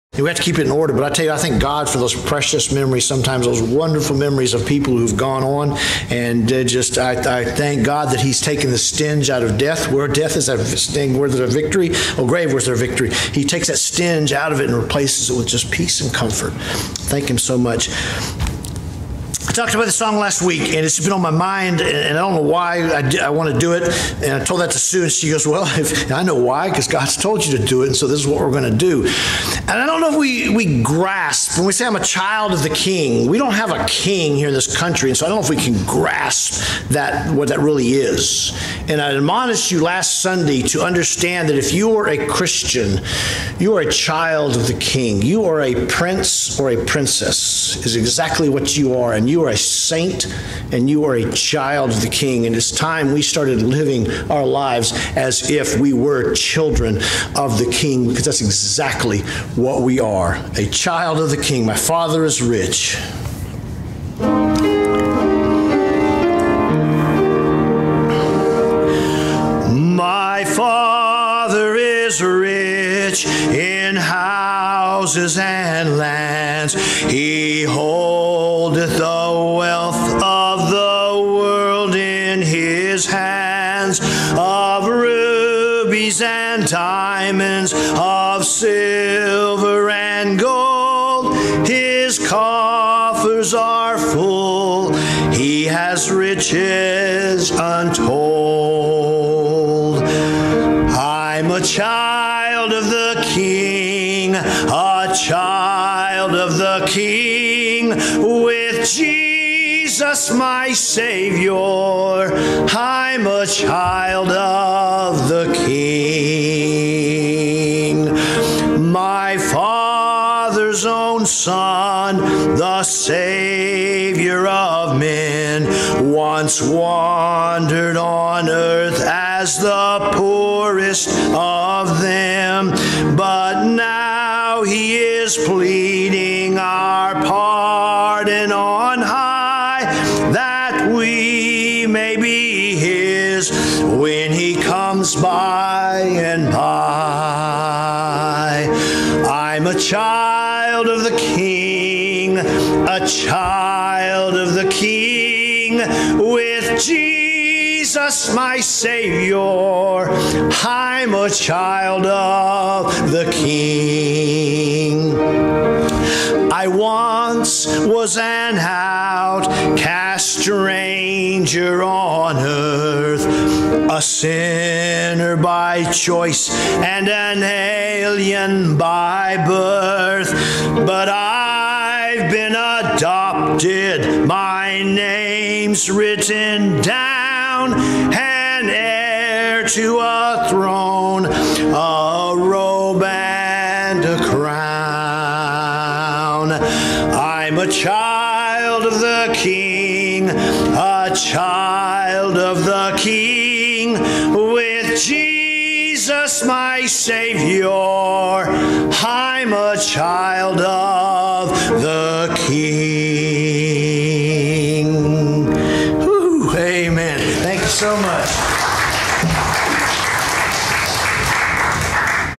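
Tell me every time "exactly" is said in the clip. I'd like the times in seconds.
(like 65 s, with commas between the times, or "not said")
47 s, 58 s.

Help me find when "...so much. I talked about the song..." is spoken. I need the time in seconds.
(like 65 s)
17 s.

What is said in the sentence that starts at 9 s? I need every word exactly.
Where death is a sting, where there's a victory, oh, grave, where's their victory?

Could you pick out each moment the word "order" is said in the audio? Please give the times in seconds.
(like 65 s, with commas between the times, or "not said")
0 s.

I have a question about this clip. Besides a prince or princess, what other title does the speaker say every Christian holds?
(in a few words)
A saint.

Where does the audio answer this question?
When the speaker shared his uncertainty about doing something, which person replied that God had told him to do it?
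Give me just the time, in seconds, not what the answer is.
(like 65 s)
24 s.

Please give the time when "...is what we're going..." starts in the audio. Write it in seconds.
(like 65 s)
28 s.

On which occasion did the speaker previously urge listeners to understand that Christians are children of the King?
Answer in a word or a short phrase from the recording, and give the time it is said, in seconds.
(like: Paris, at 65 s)
Last Sunday, at 39 s.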